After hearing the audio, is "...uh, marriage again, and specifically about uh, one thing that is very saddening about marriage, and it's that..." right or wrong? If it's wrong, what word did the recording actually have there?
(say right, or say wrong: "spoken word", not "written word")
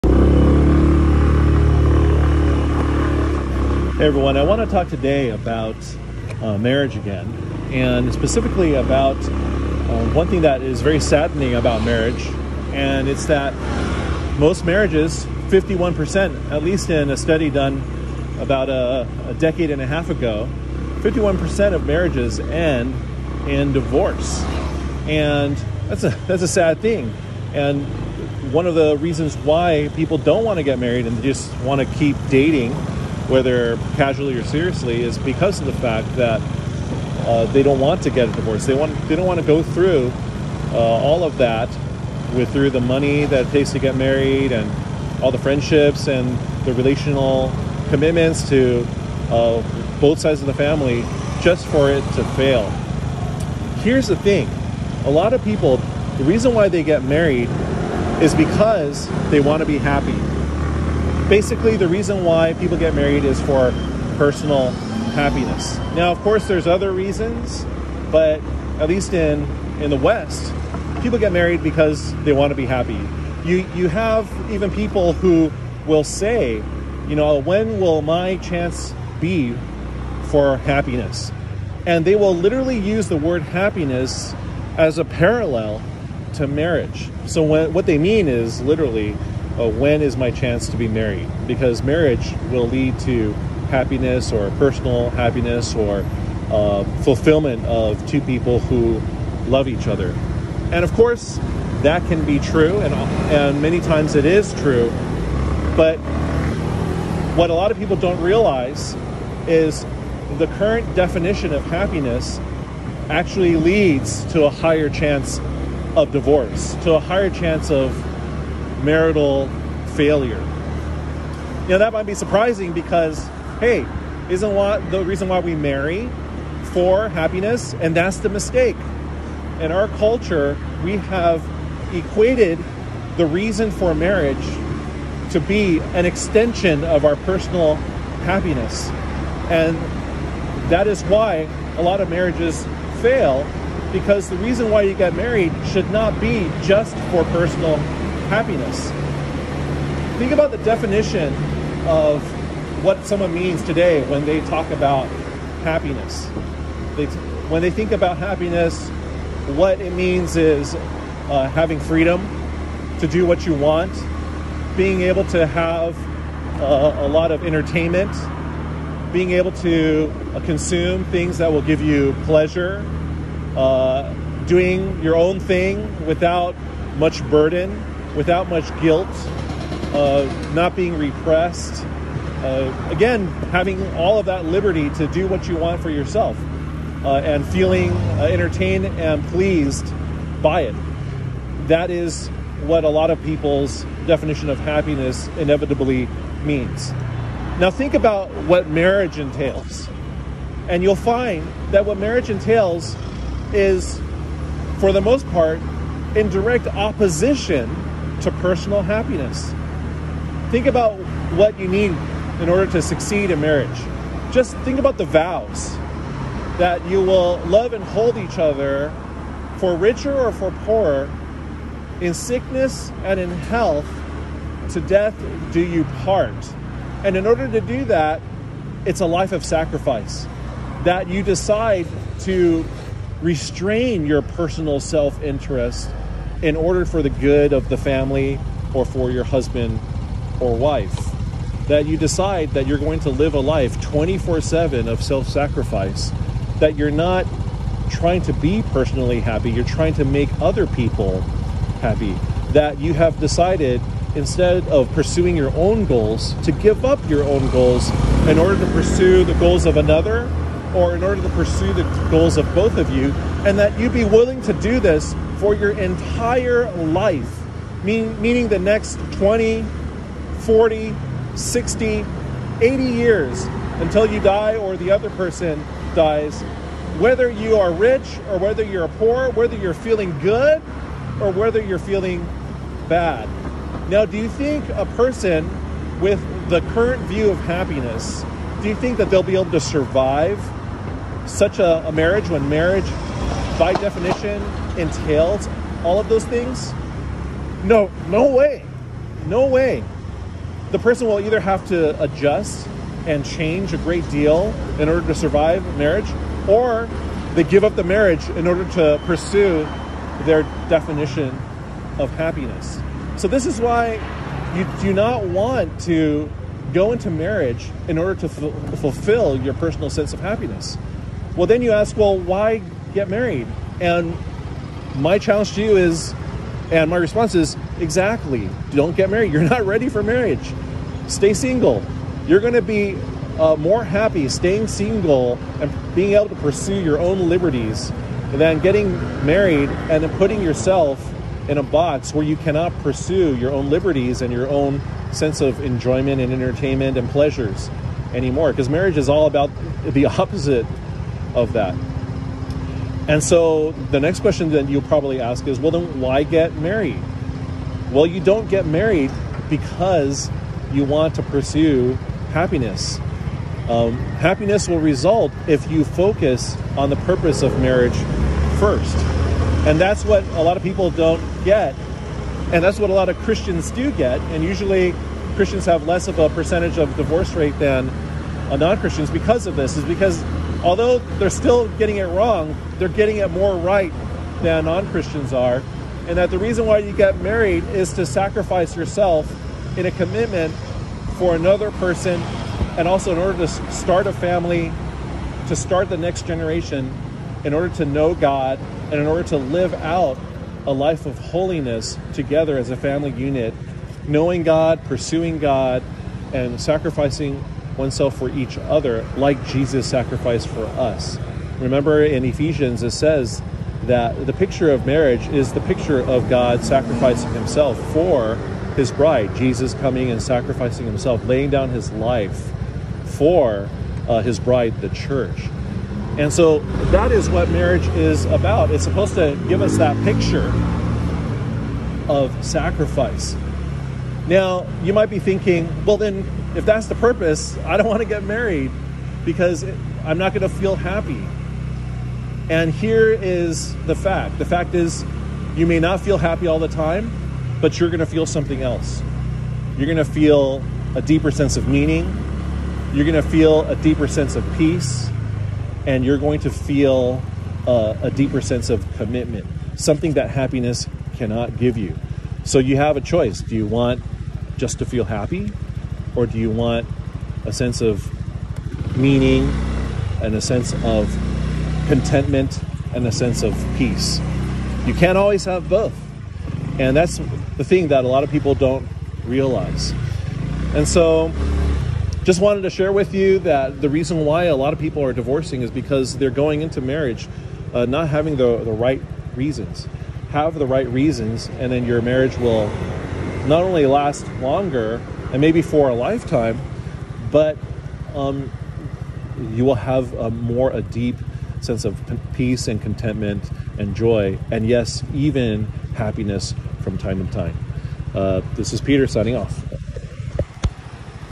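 right.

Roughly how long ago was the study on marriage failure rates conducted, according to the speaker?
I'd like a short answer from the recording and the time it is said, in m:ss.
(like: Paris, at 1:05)
a decade and a half, at 0:19.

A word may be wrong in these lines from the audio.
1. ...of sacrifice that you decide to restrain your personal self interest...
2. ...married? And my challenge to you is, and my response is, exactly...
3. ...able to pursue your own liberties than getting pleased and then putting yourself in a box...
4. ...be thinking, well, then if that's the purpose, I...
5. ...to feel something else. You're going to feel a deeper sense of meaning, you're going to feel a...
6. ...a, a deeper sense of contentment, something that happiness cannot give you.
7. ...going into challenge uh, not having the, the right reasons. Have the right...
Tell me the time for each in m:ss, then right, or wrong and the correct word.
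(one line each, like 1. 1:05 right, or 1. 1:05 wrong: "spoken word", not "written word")
1. 3:49 right
2. 5:23 right
3. 5:36 wrong: "married", not "pleased"
4. 7:15 right
5. 7:27 right
6. 7:37 wrong: "commitment", not "contentment"
7. 8:06 wrong: "marriage", not "challenge".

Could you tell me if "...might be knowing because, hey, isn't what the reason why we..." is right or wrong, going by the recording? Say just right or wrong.
wrong.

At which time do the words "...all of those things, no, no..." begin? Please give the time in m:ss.
4:55.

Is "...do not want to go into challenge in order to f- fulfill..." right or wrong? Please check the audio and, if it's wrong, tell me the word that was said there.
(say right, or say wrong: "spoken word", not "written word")
wrong: "marriage", not "challenge".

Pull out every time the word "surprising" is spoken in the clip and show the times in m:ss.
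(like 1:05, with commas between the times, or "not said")
2:02.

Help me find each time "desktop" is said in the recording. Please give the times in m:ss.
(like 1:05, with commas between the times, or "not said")
not said.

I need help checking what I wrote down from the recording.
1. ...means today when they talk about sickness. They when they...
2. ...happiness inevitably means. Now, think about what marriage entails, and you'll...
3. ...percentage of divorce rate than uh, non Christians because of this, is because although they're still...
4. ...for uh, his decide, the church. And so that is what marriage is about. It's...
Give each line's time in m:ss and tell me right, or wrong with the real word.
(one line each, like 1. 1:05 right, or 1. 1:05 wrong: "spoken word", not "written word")
1. 2:33 wrong: "happiness", not "sickness"
2. 3:14 right
3. 6:16 right
4. 7:03 wrong: "bride", not "decide".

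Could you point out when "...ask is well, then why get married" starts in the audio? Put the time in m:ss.
5:55.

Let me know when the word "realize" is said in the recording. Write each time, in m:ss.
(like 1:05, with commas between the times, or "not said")
1:48, 7:59.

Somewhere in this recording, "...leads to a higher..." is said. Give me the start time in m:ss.
1:53.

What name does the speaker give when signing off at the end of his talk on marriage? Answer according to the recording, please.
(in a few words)
Peter.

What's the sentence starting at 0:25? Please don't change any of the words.
And that's a, that's a sad thing.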